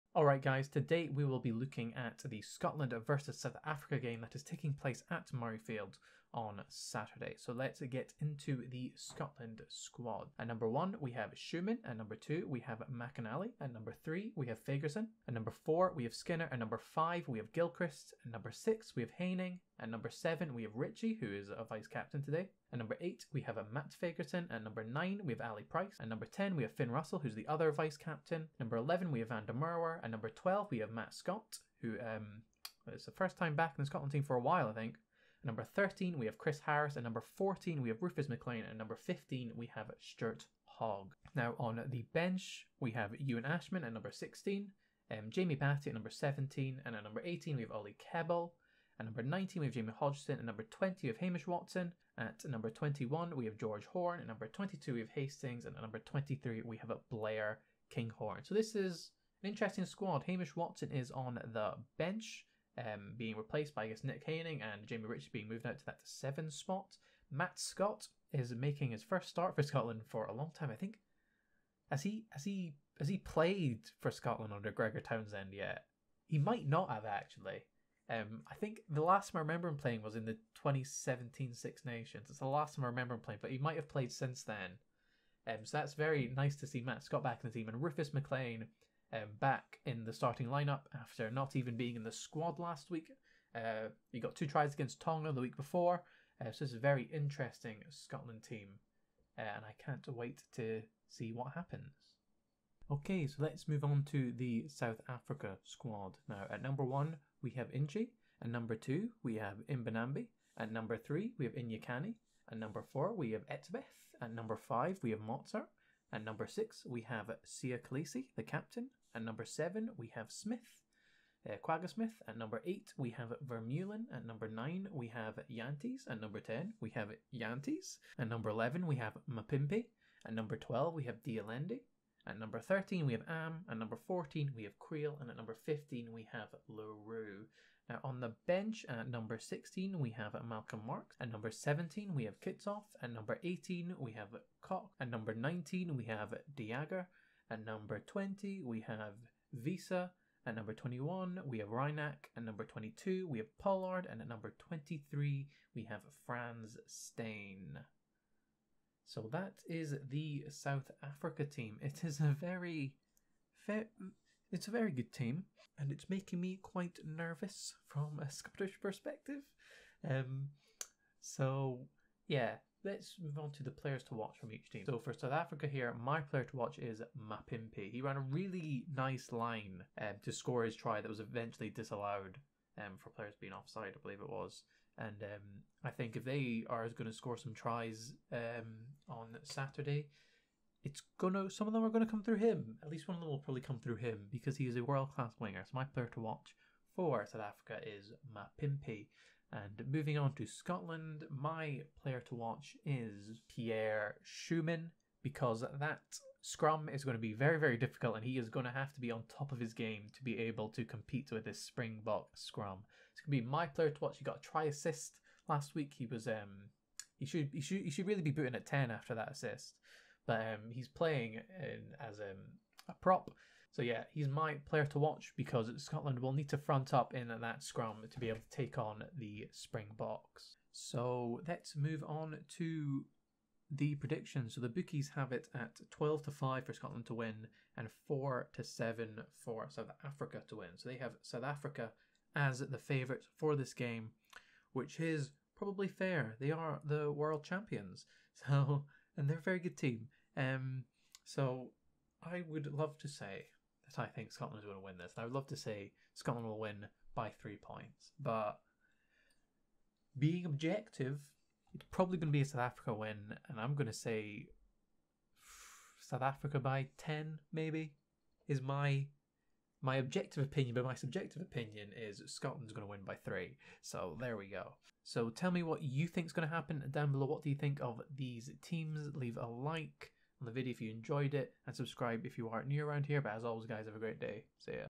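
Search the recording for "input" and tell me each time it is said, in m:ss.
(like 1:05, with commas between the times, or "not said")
not said.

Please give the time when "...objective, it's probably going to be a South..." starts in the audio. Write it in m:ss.
4:20.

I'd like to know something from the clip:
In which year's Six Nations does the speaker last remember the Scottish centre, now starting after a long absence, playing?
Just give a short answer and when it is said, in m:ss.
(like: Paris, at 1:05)
2017, at 1:20.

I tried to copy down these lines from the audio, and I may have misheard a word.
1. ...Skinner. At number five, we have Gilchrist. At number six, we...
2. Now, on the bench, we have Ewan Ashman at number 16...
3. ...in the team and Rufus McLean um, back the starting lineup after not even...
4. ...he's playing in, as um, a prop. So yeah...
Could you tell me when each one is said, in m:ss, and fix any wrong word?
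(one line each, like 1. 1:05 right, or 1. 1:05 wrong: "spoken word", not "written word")
1. 0:16 right
2. 0:41 right
3. 1:27 right
4. 3:40 right.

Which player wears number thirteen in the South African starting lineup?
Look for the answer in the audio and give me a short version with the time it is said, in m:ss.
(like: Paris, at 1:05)
Am, at 2:13.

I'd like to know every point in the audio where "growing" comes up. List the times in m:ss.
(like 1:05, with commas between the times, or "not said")
not said.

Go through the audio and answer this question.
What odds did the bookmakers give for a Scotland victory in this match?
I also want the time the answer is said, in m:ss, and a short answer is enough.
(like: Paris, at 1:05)
12 to 5, at 3:55.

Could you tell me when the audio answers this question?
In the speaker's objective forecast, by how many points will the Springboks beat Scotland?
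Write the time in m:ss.
4:26.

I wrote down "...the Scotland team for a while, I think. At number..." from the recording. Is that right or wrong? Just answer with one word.
right.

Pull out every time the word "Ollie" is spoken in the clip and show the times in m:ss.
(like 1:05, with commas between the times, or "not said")
0:47.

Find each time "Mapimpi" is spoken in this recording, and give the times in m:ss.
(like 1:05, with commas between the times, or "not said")
2:09, 2:57, 3:18.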